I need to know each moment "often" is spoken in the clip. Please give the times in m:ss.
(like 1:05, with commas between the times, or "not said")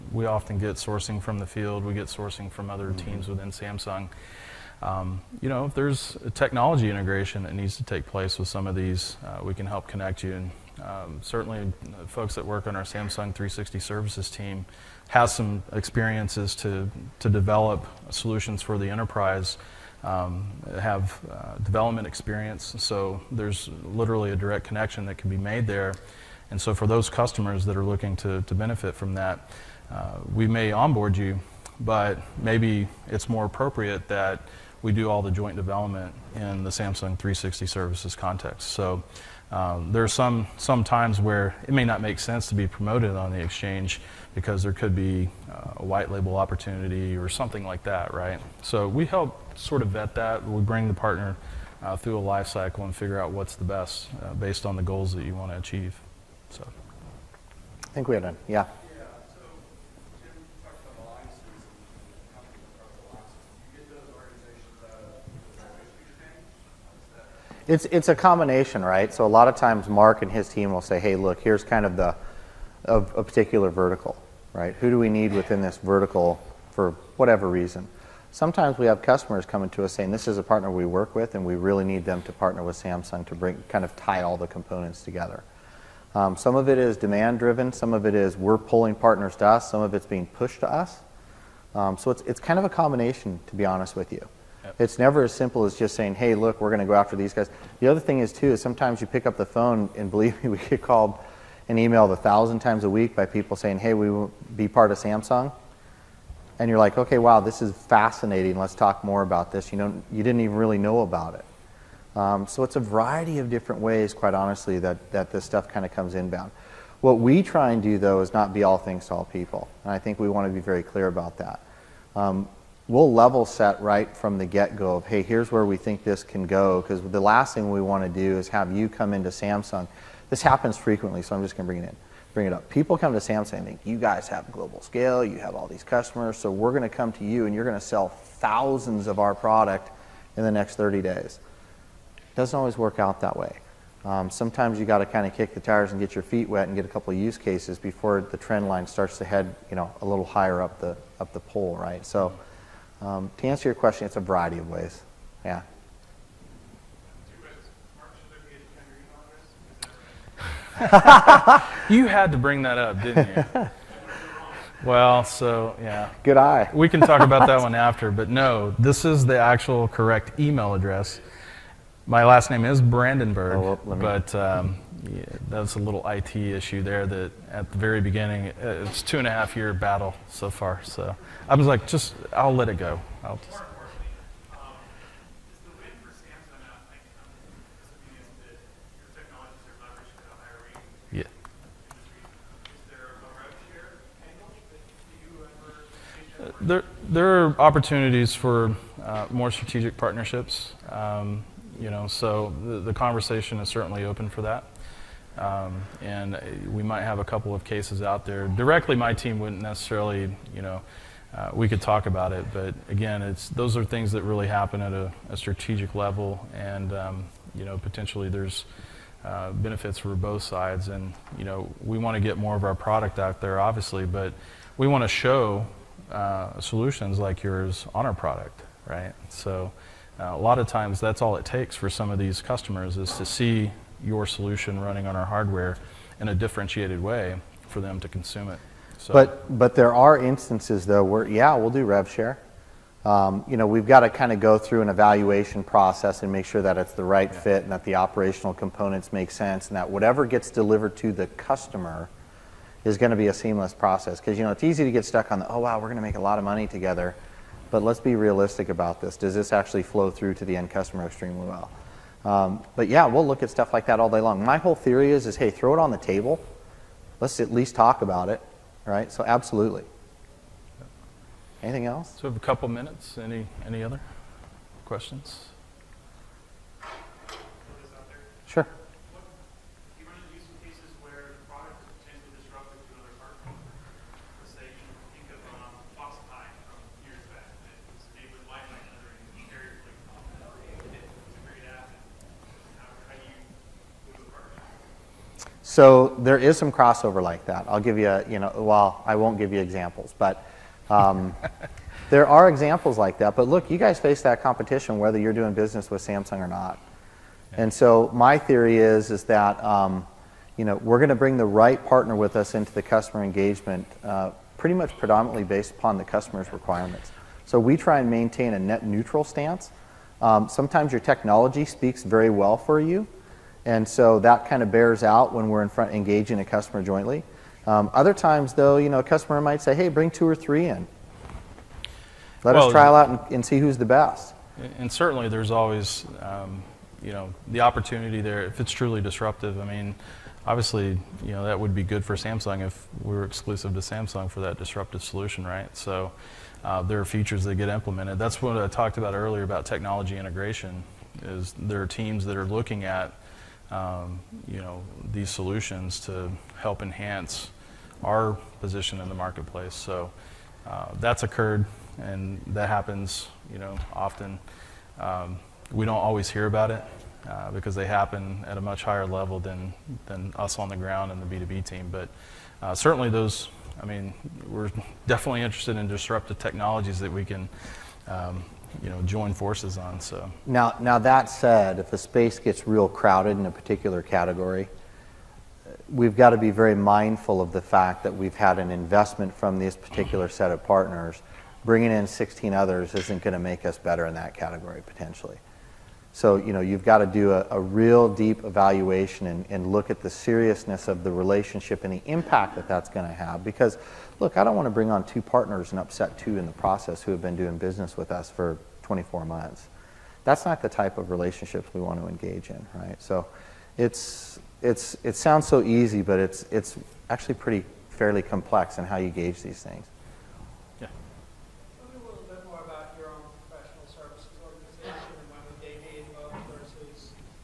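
0:00, 6:03.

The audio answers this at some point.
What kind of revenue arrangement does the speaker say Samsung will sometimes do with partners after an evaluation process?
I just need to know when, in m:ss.
4:01.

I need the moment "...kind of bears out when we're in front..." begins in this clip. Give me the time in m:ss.
5:24.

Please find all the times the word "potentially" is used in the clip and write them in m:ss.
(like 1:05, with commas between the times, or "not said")
3:37, 6:34.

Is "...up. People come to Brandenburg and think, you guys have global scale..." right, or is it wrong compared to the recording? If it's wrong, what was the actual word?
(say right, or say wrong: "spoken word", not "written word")
wrong: "Samsung", not "Brandenburg".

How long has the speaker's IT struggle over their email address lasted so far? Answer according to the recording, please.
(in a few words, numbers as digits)
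2.5 years.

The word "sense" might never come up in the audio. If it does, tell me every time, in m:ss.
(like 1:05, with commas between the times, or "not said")
0:42, 4:09.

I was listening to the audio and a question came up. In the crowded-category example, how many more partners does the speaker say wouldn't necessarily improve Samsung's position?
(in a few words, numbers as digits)
16.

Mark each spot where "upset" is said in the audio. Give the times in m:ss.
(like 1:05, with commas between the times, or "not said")
6:45.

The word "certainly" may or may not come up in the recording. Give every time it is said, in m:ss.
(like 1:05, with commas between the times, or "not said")
0:11, 3:23, 5:34, 6:12.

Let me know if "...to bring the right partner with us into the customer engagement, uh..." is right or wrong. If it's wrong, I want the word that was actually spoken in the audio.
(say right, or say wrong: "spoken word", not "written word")
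right.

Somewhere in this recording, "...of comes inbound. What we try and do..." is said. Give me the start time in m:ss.
1:55.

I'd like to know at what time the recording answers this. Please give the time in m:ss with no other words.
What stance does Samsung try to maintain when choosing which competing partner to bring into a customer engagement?
5:18.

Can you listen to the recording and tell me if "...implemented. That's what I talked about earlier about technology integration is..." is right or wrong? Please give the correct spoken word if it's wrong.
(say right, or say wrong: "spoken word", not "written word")
right.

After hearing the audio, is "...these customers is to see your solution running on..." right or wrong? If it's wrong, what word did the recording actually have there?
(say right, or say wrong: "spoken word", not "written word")
right.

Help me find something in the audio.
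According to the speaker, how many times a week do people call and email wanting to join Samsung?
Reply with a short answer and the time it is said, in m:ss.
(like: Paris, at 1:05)
1000, at 1:42.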